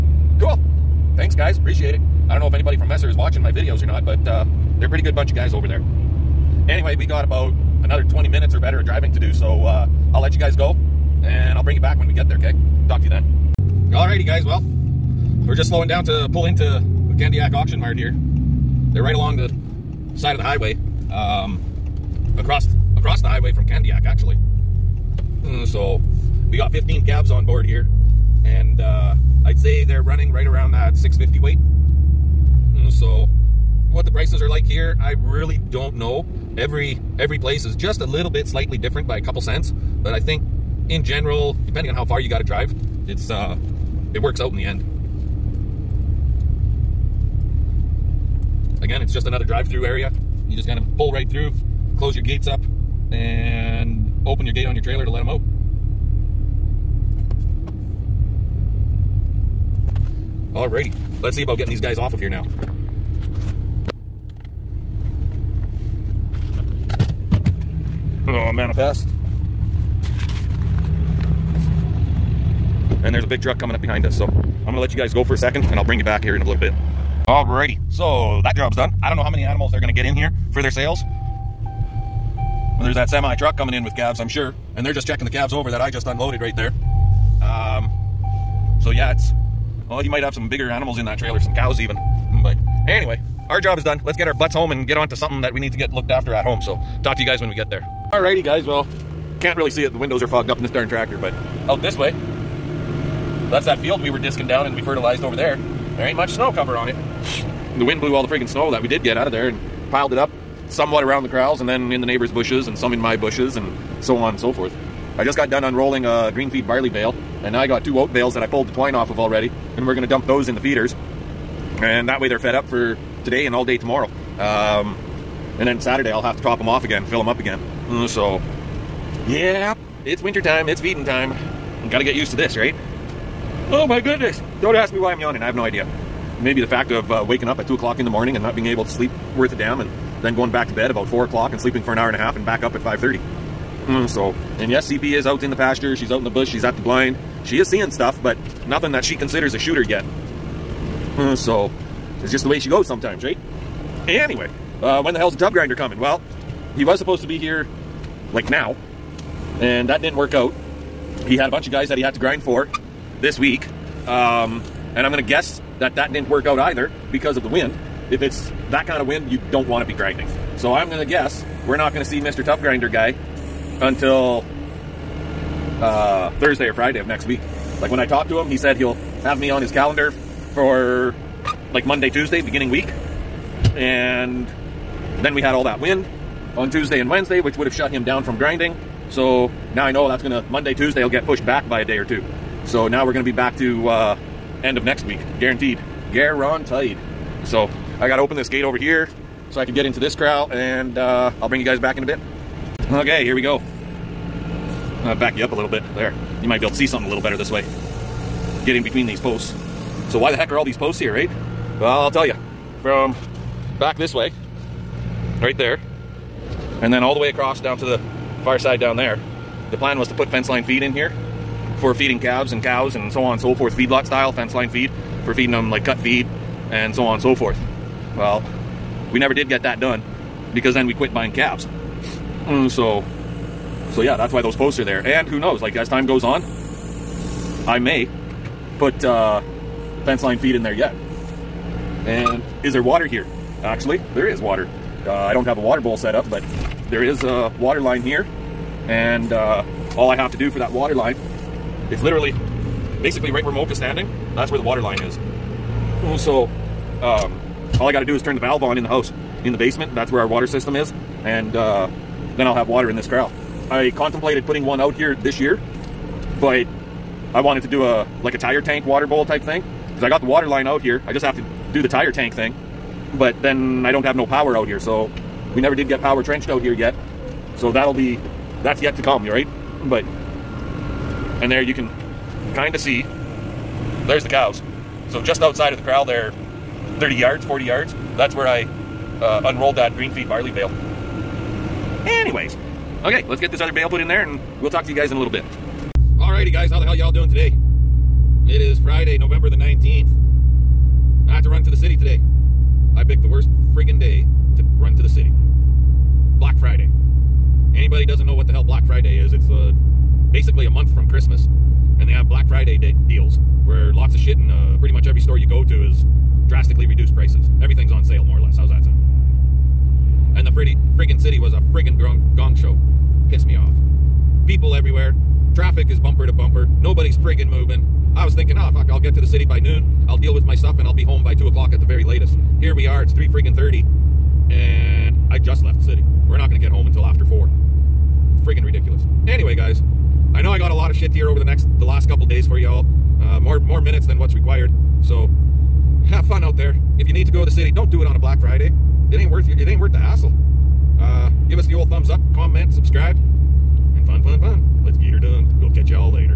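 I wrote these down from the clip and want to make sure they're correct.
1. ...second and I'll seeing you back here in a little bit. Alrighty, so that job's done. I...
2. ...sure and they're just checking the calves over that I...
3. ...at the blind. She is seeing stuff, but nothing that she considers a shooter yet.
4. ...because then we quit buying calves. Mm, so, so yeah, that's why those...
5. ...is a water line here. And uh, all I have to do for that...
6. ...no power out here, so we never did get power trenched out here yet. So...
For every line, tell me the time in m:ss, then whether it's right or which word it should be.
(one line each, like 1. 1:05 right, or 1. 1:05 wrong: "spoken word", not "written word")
1. 1:15 wrong: "bring", not "seeing"
2. 1:24 right
3. 2:26 right
4. 3:50 right
5. 4:07 right
6. 4:34 right.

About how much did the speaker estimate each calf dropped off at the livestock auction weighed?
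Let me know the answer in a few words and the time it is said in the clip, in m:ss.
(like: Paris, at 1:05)
650, at 0:30.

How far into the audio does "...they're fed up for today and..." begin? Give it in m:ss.
2:02.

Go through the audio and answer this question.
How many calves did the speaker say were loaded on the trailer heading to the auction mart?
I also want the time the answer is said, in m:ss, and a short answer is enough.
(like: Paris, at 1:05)
15, at 0:26.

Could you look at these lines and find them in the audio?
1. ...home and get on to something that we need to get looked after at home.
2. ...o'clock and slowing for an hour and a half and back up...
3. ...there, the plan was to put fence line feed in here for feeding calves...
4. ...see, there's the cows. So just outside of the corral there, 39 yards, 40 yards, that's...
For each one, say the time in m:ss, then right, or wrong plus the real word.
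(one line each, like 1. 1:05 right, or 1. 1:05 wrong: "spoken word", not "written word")
1. 1:34 right
2. 2:21 wrong: "sleeping", not "slowing"
3. 3:38 right
4. 4:42 wrong: "30", not "39".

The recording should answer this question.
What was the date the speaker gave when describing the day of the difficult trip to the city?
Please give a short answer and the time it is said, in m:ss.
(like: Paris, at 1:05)
Friday, November 19, at 4:58.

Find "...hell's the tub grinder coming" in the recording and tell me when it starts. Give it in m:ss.
2:35.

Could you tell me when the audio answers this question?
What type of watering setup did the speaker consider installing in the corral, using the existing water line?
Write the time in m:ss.
4:28.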